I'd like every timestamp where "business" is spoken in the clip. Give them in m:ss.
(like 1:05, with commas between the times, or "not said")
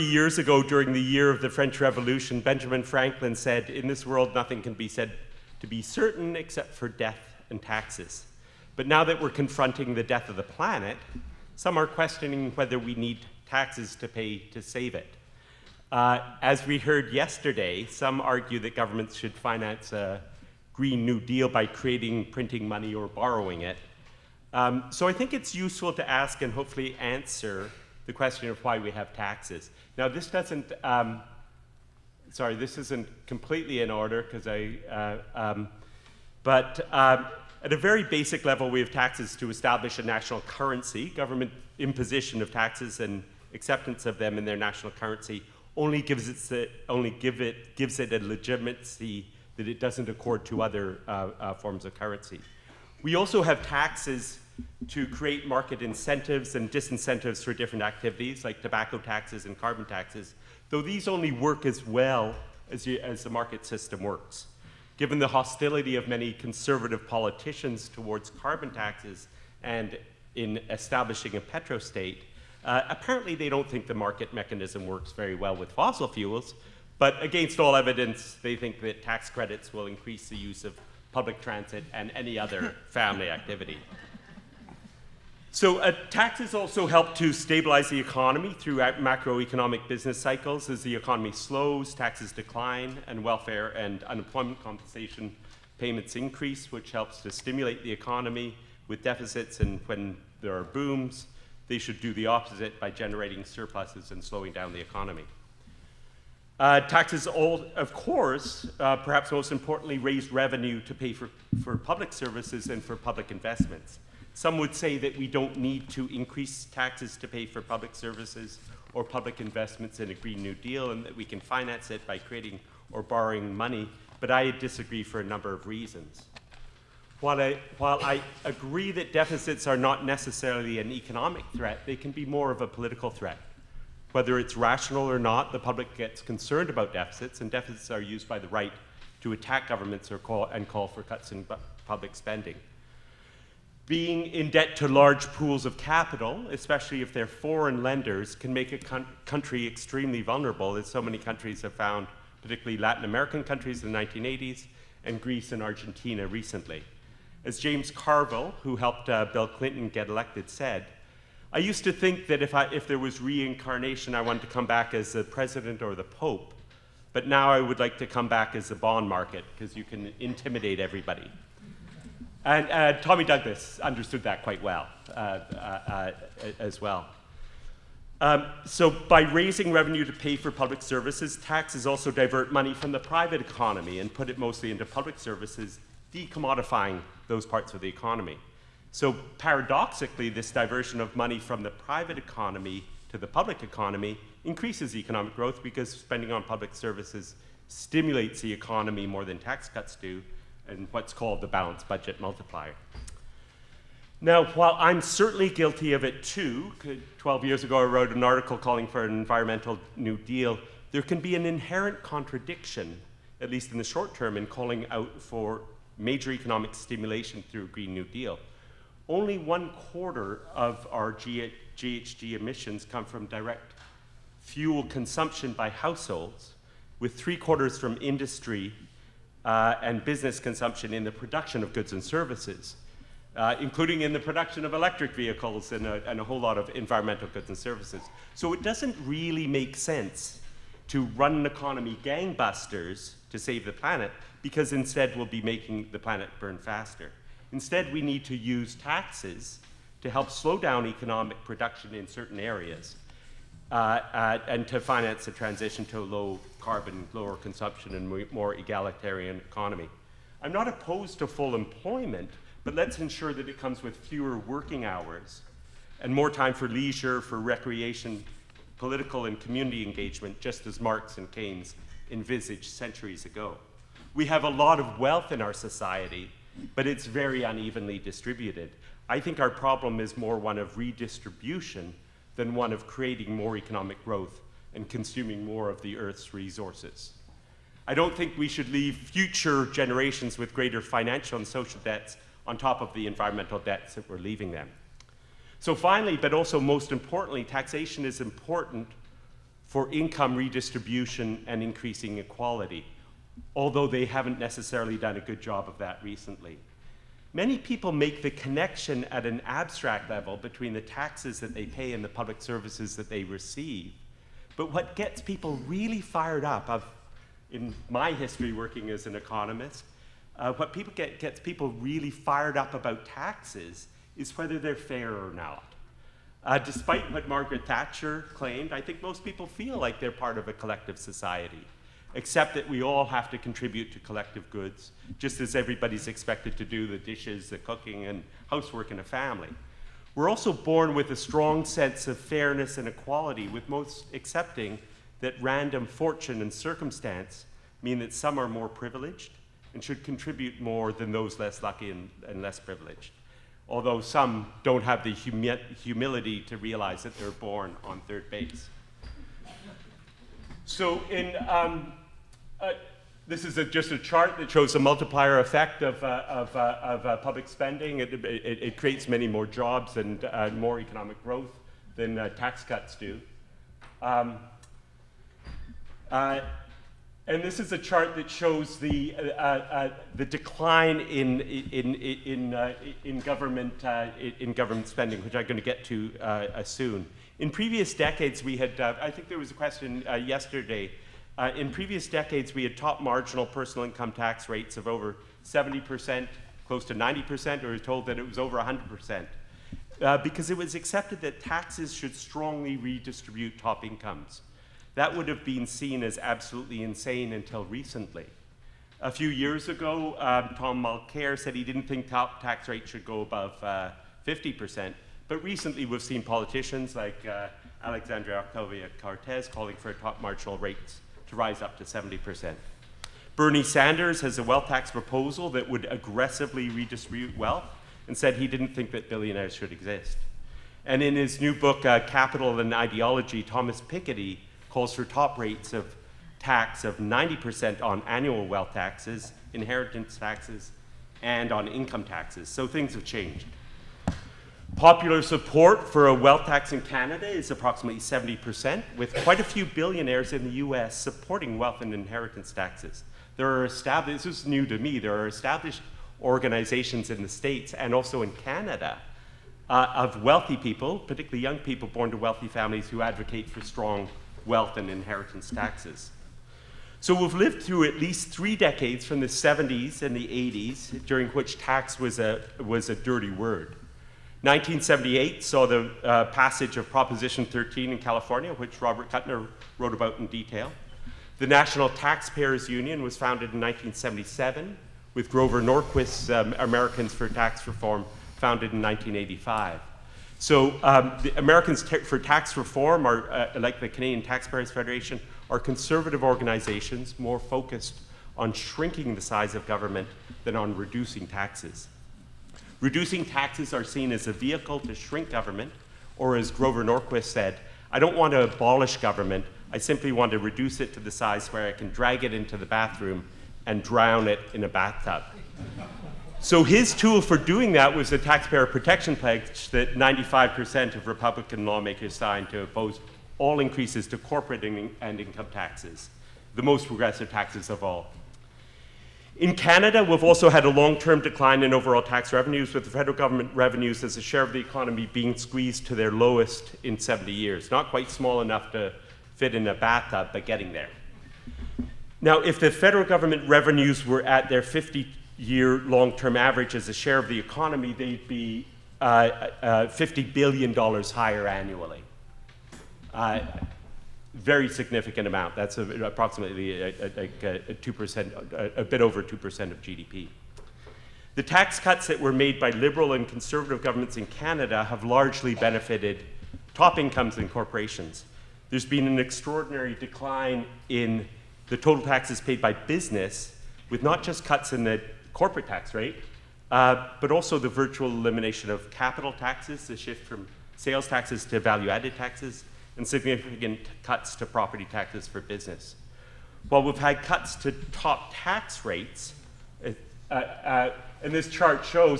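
1:29, 3:50, 9:32, 9:45.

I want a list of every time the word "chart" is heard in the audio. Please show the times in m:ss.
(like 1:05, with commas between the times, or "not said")
6:03, 6:17, 9:51.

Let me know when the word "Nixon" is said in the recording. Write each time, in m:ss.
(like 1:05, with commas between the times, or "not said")
not said.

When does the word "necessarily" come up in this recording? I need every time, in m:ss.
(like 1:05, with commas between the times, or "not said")
2:10, 5:04.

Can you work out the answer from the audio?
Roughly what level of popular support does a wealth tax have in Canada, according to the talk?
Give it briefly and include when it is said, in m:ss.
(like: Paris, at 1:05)
70%, at 7:27.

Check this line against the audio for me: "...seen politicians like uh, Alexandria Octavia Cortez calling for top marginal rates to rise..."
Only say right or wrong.
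right.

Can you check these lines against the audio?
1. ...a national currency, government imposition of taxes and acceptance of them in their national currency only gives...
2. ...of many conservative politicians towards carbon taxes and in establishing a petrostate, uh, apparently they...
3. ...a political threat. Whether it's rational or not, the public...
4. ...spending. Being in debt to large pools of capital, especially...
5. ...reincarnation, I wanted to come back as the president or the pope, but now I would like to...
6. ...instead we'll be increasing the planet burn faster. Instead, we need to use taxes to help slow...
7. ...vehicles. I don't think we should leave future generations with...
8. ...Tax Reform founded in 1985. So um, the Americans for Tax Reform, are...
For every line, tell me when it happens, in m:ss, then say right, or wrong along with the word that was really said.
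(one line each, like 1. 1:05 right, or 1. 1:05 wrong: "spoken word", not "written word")
1. 0:39 right
2. 1:05 right
3. 2:12 right
4. 2:22 right
5. 2:43 right
6. 4:04 wrong: "making", not "increasing"
7. 4:46 wrong: "resources", not "vehicles"
8. 8:07 right.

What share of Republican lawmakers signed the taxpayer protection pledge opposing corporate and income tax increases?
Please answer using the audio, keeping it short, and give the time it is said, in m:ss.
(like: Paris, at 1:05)
95%, at 8:39.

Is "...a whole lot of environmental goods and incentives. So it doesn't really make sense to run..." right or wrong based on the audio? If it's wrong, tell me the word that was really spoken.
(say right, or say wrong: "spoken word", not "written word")
wrong: "services", not "incentives".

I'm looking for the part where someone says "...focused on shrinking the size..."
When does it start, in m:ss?
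8:17.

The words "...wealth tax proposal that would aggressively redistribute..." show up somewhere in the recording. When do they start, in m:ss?
7:04.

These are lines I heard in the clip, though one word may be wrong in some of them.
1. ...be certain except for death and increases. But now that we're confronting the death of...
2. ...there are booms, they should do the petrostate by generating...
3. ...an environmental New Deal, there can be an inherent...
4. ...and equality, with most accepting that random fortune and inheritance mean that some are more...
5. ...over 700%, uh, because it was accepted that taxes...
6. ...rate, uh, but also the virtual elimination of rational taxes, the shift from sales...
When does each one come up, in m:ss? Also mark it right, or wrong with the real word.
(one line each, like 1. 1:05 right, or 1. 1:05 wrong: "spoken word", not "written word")
1. 0:05 wrong: "taxes", not "increases"
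2. 1:40 wrong: "opposite", not "petrostate"
3. 3:29 right
4. 5:42 wrong: "circumstance", not "inheritance"
5. 6:38 wrong: "100", not "700"
6. 9:35 wrong: "capital", not "rational".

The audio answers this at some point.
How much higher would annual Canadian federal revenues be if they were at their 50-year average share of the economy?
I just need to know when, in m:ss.
9:09.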